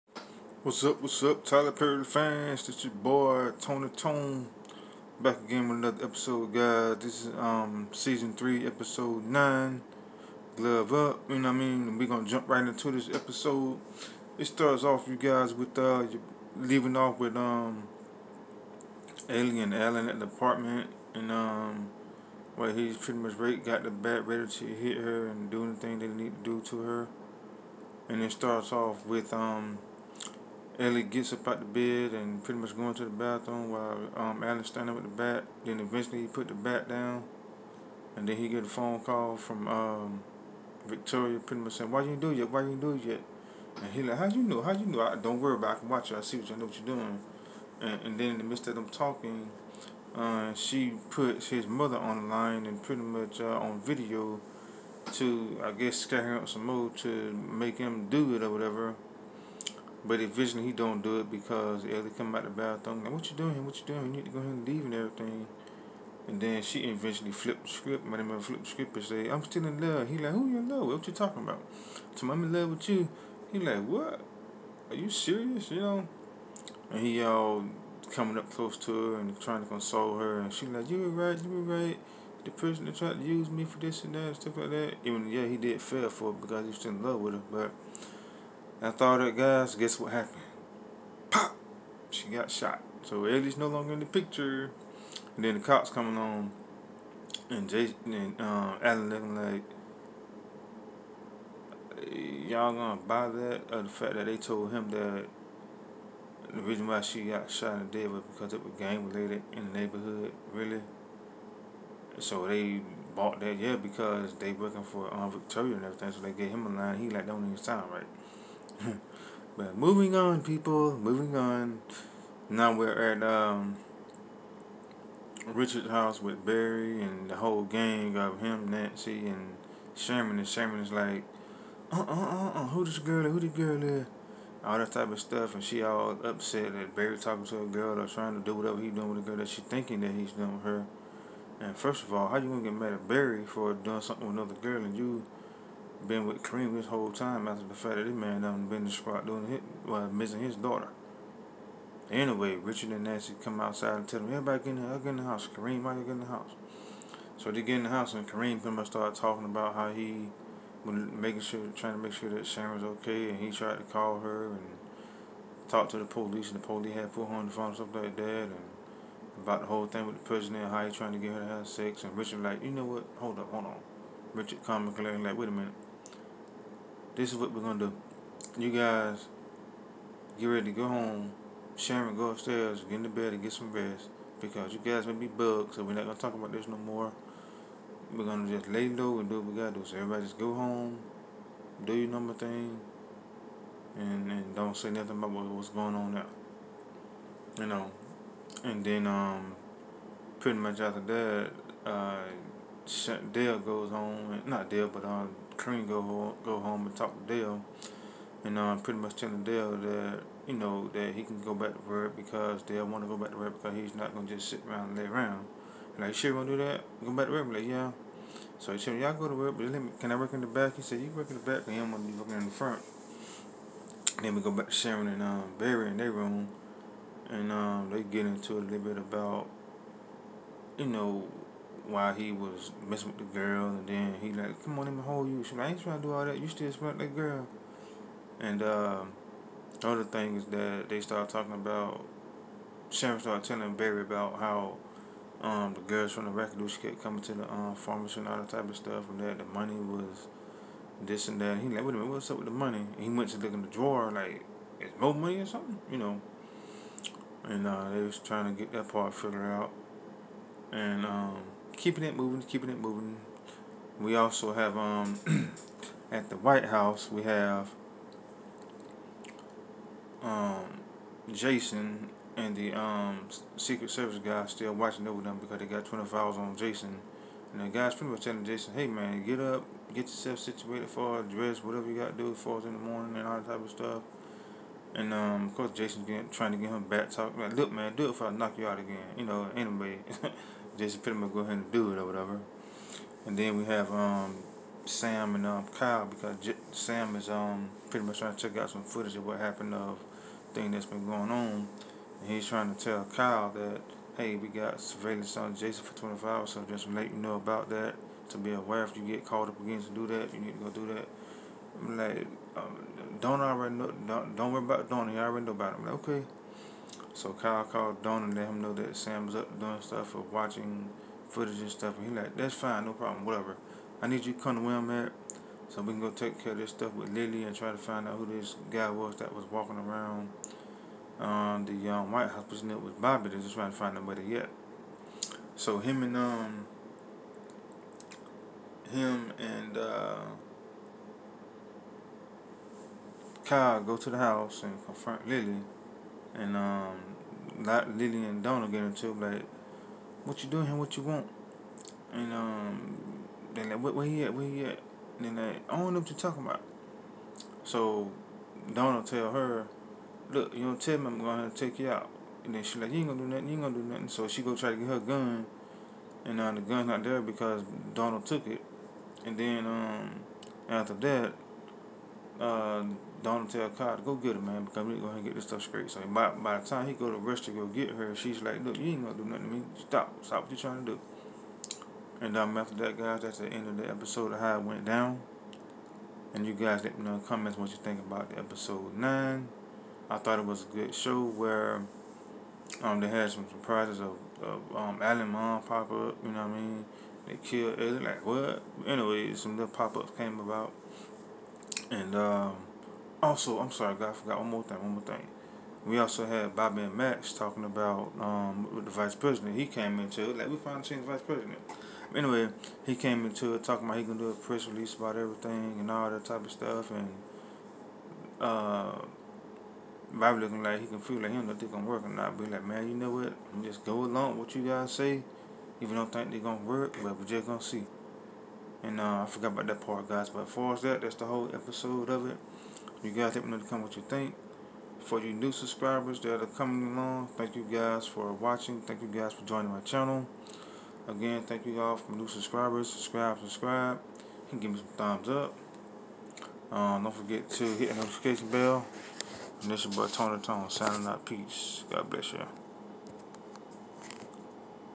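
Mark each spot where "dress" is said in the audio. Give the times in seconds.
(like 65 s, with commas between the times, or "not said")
281 s.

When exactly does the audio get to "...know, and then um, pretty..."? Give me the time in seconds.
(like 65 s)
197 s.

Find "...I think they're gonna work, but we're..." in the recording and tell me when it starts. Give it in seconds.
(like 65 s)
426 s.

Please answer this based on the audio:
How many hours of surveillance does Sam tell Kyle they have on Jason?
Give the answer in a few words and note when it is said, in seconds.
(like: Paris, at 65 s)
25, at 305 s.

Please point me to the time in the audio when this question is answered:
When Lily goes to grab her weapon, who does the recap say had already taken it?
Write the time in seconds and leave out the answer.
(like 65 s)
367 s.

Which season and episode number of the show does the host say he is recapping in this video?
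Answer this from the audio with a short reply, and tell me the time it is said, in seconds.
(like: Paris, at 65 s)
Season 3, episode 9, at 7 s.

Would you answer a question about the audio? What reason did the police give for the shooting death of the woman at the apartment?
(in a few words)
Gang related.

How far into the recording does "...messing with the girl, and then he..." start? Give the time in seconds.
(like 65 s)
232 s.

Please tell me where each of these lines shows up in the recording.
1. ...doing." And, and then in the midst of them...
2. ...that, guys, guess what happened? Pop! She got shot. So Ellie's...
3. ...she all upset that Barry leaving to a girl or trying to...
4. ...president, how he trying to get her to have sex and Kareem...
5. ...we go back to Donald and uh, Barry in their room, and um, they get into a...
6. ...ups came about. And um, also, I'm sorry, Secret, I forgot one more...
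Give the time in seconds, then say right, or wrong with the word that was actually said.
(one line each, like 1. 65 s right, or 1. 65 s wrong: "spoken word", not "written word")
1. 46 s right
2. 89 s right
3. 135 s wrong: "talking", not "leaving"
4. 170 s wrong: "Richard", not "Kareem"
5. 224 s wrong: "Sharon", not "Donald"
6. 399 s wrong: "God", not "Secret".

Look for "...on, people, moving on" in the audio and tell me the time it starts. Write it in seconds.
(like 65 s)
120 s.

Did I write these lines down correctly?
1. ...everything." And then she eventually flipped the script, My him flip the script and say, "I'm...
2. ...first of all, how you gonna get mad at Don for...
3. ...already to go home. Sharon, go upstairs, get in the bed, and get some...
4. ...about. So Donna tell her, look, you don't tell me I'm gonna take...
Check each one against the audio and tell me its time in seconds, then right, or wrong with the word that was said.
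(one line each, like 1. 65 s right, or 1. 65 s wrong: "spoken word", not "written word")
1. 64 s right
2. 141 s wrong: "Barry", not "Don"
3. 180 s wrong: "ready", not "already"
4. 356 s right.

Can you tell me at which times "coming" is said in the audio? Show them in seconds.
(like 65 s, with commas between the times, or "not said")
78 s, 247 s, 436 s.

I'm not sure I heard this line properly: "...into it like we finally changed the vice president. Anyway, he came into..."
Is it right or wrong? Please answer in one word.
right.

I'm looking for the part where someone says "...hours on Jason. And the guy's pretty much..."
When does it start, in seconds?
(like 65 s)
276 s.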